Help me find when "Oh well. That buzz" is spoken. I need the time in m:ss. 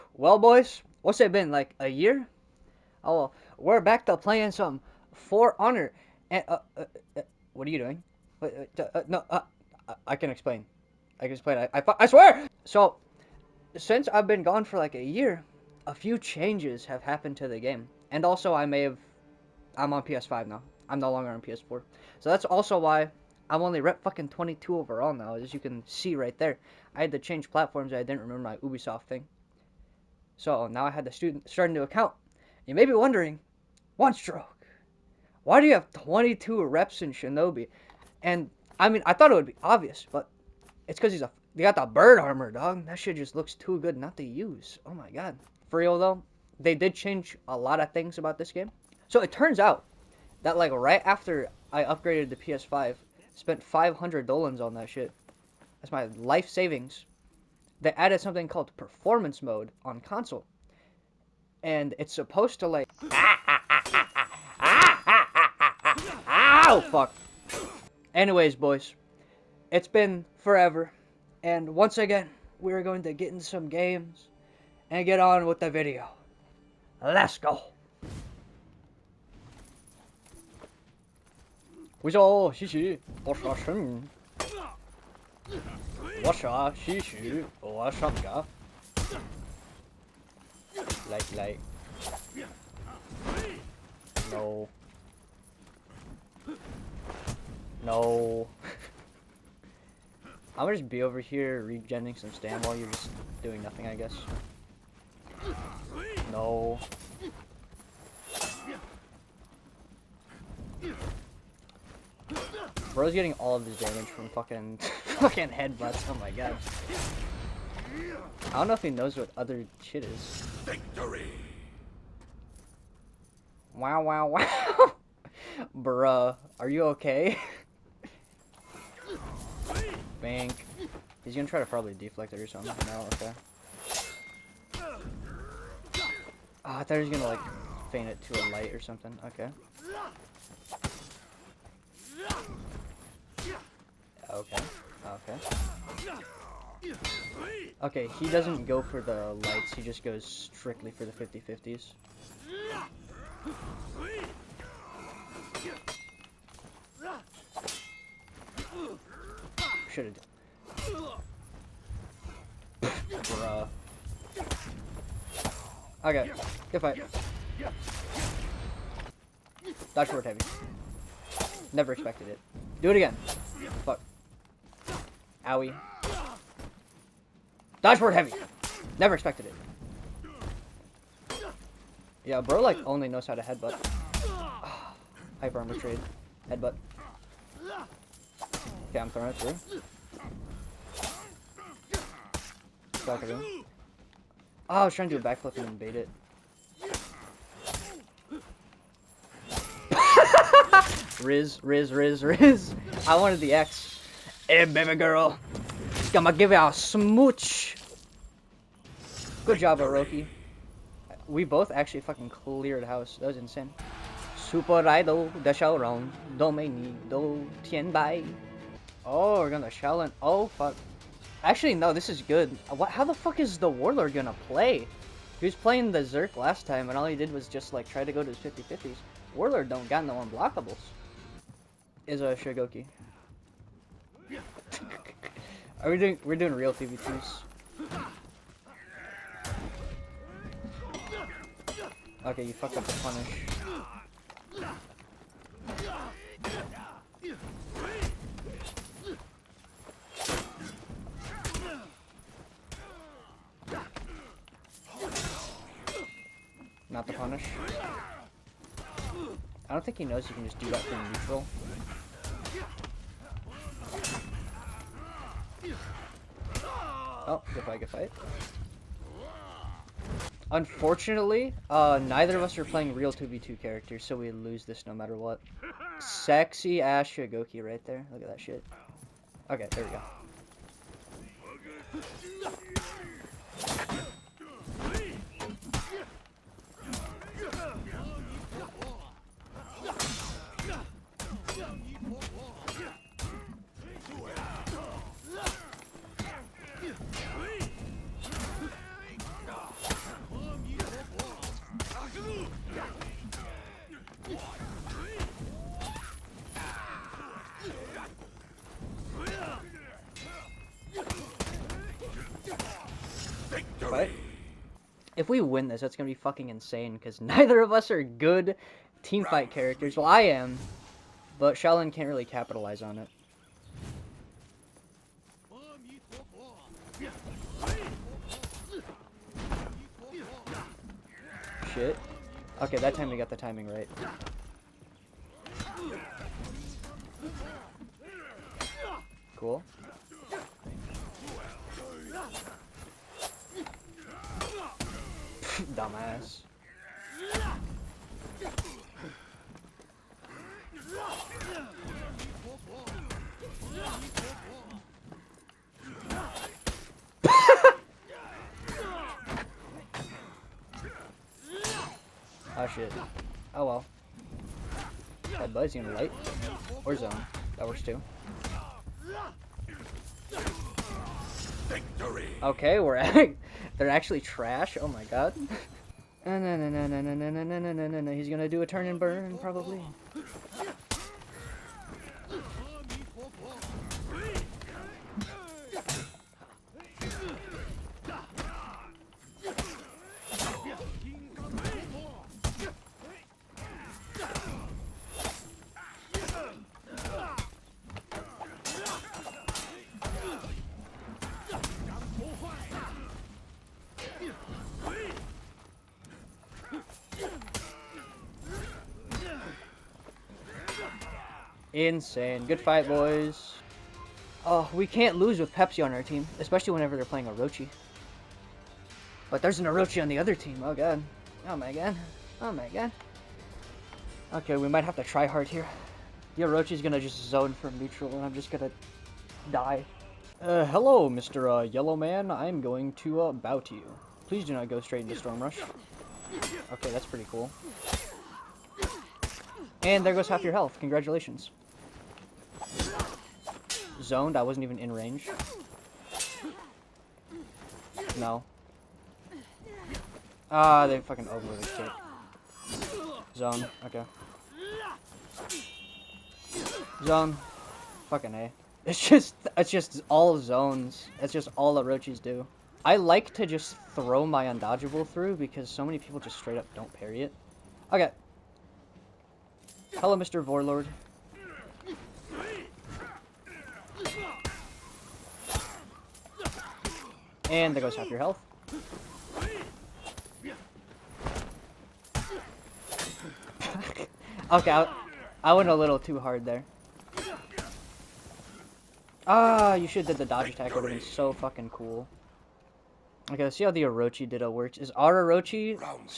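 6:03.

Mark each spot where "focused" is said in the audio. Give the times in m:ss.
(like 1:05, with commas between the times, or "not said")
not said.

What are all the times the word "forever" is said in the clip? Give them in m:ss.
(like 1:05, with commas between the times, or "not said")
1:10.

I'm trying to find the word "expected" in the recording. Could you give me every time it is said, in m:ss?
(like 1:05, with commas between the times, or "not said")
2:51, 2:59.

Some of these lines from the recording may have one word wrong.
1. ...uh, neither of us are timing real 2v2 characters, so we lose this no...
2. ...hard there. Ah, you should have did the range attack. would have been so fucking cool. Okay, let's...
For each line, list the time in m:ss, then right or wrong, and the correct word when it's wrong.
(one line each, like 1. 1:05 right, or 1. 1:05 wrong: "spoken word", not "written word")
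1. 4:31 wrong: "playing", not "timing"
2. 8:06 wrong: "dodge", not "range".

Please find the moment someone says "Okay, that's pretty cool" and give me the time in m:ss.
7:16.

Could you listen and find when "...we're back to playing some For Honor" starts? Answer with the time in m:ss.
0:03.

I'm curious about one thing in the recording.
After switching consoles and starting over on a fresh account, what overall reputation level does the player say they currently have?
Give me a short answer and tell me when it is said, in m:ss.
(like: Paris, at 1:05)
22, at 0:24.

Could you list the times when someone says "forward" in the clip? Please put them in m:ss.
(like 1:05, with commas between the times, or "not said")
2:50, 2:57.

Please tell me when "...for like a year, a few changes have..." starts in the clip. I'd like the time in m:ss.
0:14.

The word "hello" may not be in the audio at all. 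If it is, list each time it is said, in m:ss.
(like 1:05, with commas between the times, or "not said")
7:10, 7:49.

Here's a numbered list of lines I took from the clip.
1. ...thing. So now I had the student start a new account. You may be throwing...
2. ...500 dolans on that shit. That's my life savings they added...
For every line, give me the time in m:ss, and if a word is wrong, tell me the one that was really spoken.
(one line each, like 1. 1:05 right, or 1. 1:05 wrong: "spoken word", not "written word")
1. 0:29 wrong: "wondering", not "throwing"
2. 0:53 right.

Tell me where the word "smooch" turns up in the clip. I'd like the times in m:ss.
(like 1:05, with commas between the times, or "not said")
3:26.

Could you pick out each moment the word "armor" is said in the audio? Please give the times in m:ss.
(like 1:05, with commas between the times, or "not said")
0:42, 3:05.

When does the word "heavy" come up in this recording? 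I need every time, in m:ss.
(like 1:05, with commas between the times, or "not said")
2:50, 2:58.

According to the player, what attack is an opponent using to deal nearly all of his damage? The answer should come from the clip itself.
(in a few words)
headbutts.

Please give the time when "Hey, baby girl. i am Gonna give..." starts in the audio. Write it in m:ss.
3:24.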